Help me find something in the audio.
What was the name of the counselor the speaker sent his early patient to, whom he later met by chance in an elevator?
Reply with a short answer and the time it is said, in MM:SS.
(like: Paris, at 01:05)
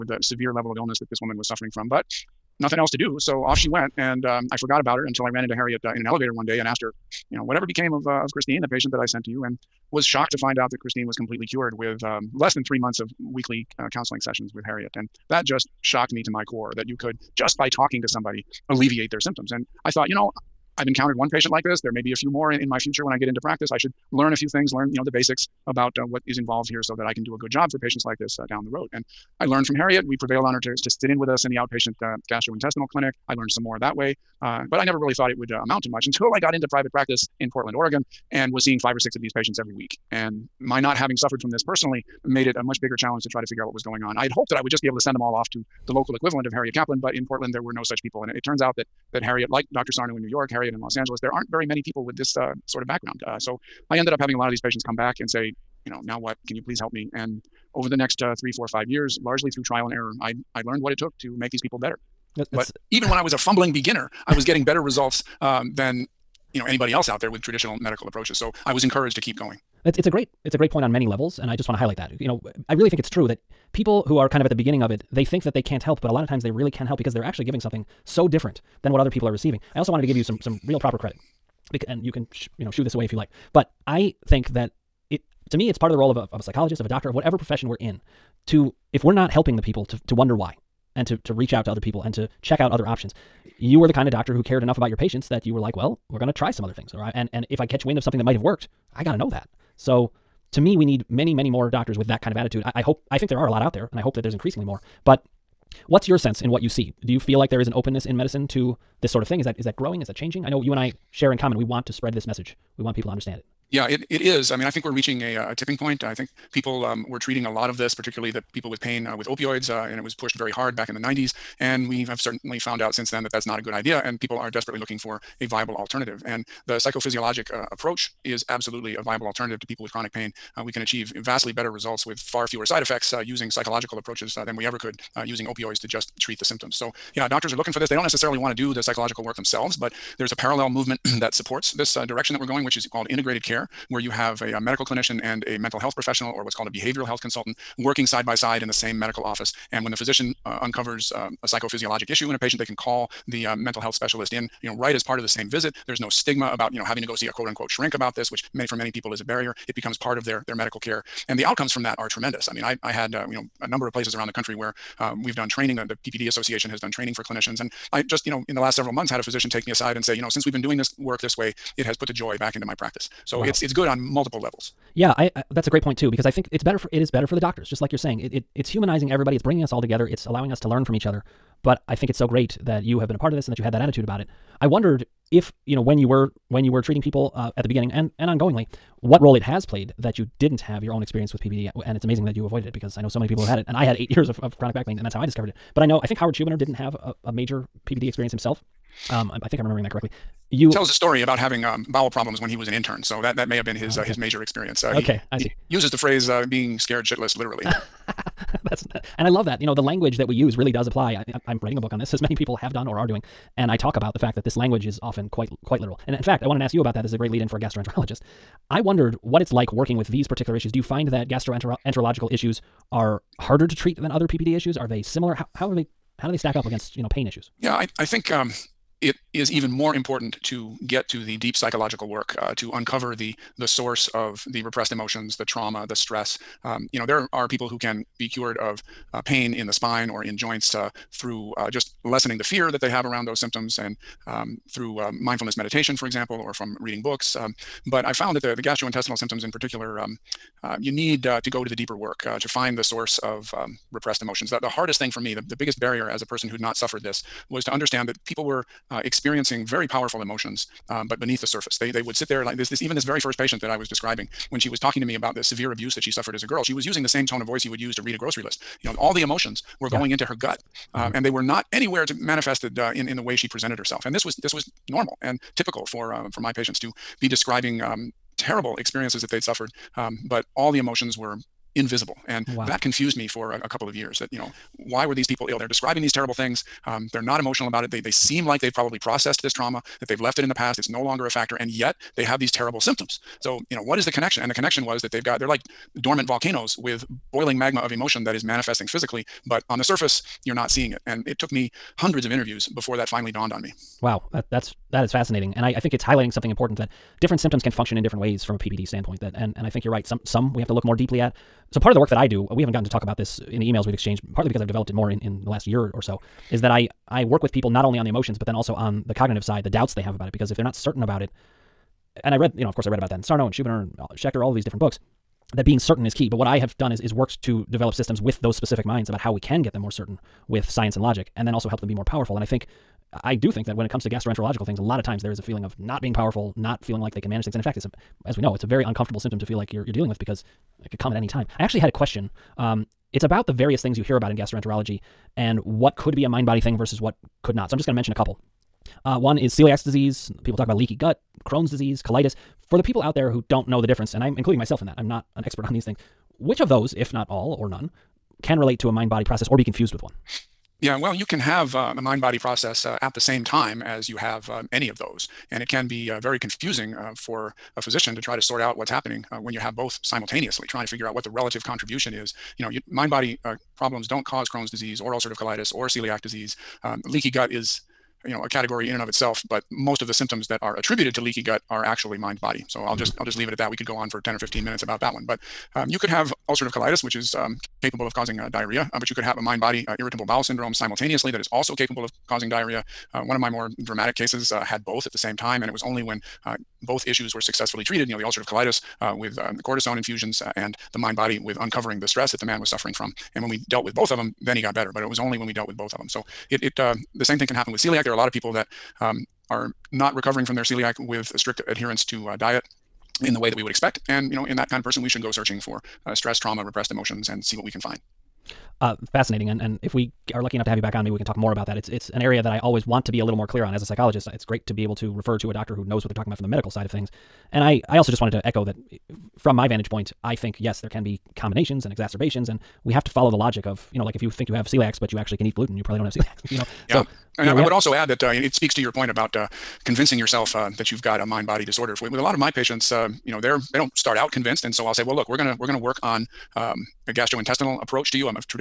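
Harriet Kaplan, at 00:46.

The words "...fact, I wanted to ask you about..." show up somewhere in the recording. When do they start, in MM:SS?
03:36.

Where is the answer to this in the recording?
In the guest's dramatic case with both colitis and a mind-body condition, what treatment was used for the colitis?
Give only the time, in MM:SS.
06:39.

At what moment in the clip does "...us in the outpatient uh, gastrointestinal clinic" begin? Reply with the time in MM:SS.
00:31.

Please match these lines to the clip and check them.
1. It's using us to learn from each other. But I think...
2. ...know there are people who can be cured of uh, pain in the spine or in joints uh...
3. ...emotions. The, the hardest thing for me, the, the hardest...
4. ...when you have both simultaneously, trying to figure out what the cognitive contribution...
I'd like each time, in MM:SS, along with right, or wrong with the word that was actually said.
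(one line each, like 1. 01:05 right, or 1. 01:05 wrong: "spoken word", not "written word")
1. 03:00 wrong: "allowing", not "using"
2. 03:56 right
3. 04:14 wrong: "biggest", not "hardest"
4. 06:09 wrong: "relative", not "cognitive".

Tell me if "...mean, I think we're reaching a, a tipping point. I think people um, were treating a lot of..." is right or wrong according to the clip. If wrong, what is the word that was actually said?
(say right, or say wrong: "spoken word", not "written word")
right.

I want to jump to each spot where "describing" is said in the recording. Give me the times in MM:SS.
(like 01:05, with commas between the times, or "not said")
04:23, 04:37, 04:45.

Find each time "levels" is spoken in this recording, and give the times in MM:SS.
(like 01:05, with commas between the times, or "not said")
00:00, 01:11, 02:54.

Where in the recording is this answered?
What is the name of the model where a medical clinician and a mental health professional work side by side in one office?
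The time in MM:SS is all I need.
02:23.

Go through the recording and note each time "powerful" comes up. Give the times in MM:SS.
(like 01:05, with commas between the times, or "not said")
04:19, 05:32, 05:36.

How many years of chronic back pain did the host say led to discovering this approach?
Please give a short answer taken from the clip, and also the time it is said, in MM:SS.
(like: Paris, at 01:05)
8, at 03:13.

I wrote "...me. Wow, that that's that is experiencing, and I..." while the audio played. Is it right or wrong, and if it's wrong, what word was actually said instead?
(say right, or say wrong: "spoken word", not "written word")
wrong: "fascinating", not "experiencing".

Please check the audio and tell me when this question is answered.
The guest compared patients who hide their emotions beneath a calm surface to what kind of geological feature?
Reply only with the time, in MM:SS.
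04:56.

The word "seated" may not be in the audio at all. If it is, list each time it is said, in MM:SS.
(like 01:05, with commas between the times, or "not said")
not said.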